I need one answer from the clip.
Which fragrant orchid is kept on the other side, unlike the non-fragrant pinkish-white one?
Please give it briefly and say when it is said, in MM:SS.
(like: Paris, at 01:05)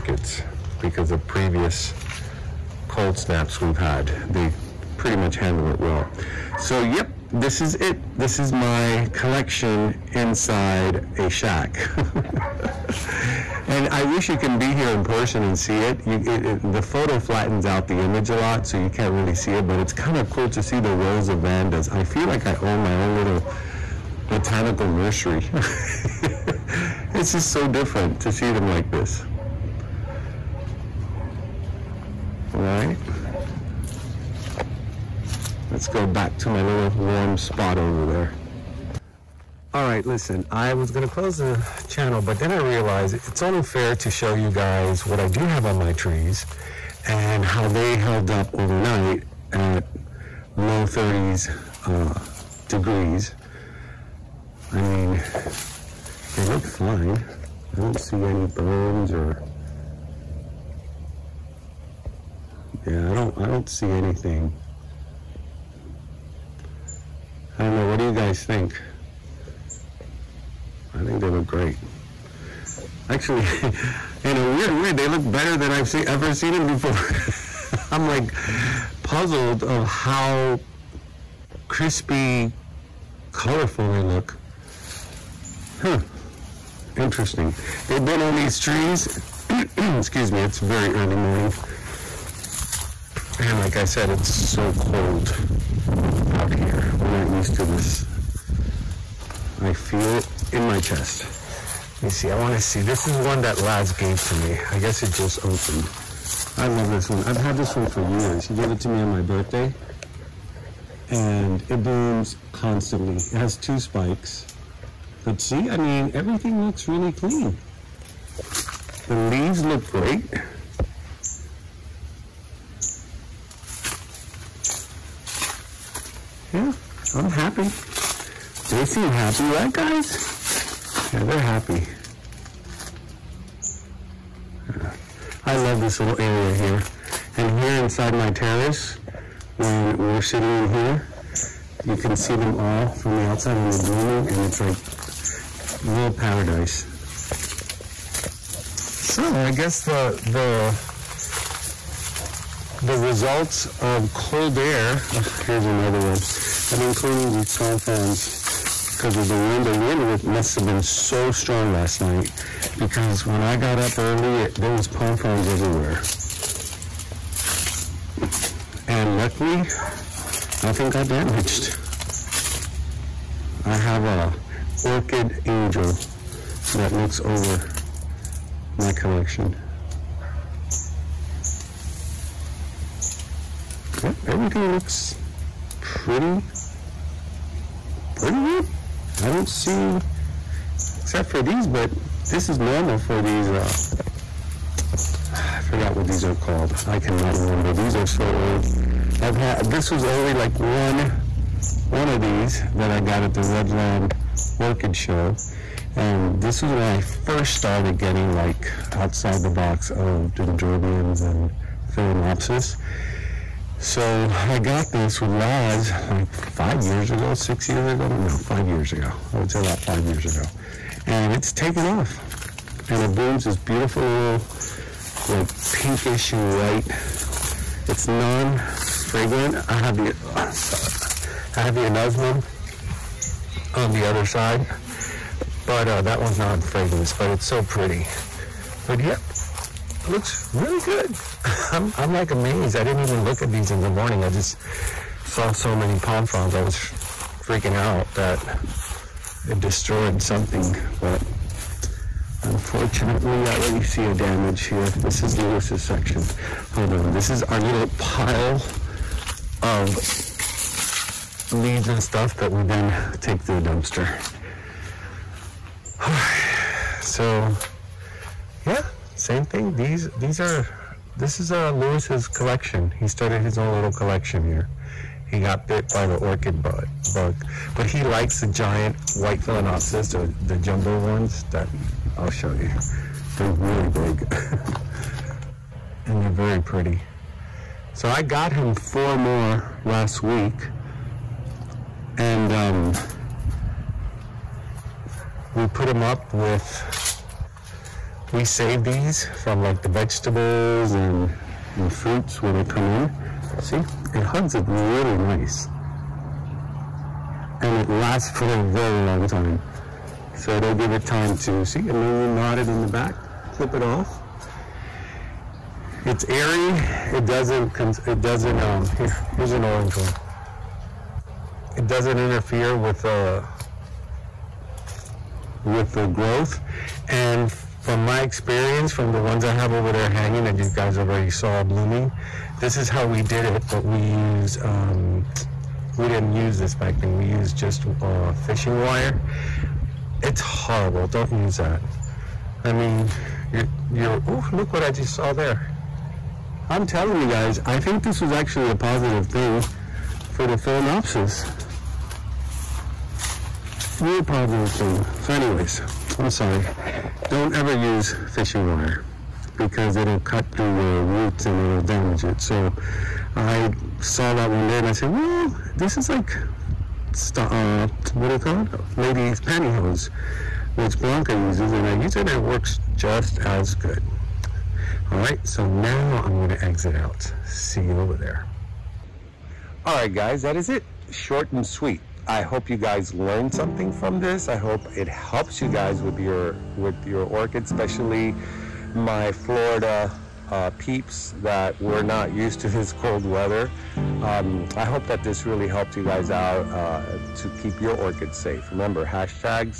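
anosmum, at 03:51.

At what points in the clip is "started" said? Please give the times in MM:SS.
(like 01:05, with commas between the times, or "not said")
03:27, 04:33.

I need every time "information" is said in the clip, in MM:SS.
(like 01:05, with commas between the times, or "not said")
not said.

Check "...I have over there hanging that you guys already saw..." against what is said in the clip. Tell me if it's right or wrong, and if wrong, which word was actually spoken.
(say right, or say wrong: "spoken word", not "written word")
right.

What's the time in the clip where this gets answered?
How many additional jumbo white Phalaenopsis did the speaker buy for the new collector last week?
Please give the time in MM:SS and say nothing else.
04:48.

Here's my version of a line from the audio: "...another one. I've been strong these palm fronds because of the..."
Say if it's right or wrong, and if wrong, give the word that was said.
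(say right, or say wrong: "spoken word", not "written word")
wrong: "cleaning", not "strong".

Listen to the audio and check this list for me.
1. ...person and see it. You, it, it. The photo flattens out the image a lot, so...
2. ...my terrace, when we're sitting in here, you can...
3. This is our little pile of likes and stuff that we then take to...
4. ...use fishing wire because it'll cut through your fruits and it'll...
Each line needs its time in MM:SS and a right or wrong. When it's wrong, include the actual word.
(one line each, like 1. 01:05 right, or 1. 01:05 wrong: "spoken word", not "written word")
1. 00:15 right
2. 02:18 right
3. 04:17 wrong: "leaves", not "likes"
4. 05:57 wrong: "roots", not "fruits".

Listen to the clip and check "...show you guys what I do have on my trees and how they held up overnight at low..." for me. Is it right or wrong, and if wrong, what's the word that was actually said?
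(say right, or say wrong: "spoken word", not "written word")
right.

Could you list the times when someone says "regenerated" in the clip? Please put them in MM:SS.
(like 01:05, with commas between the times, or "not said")
not said.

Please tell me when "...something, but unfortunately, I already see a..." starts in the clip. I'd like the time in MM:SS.
04:10.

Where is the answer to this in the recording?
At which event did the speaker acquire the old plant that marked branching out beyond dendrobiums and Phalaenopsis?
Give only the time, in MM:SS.
03:23.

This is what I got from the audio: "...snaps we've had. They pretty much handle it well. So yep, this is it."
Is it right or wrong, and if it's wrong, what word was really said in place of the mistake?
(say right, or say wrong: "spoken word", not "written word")
right.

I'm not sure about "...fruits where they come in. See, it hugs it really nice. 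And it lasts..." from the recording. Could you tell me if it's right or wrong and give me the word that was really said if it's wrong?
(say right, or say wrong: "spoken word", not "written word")
right.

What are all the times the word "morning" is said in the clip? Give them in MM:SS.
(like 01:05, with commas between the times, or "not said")
01:31, 04:03.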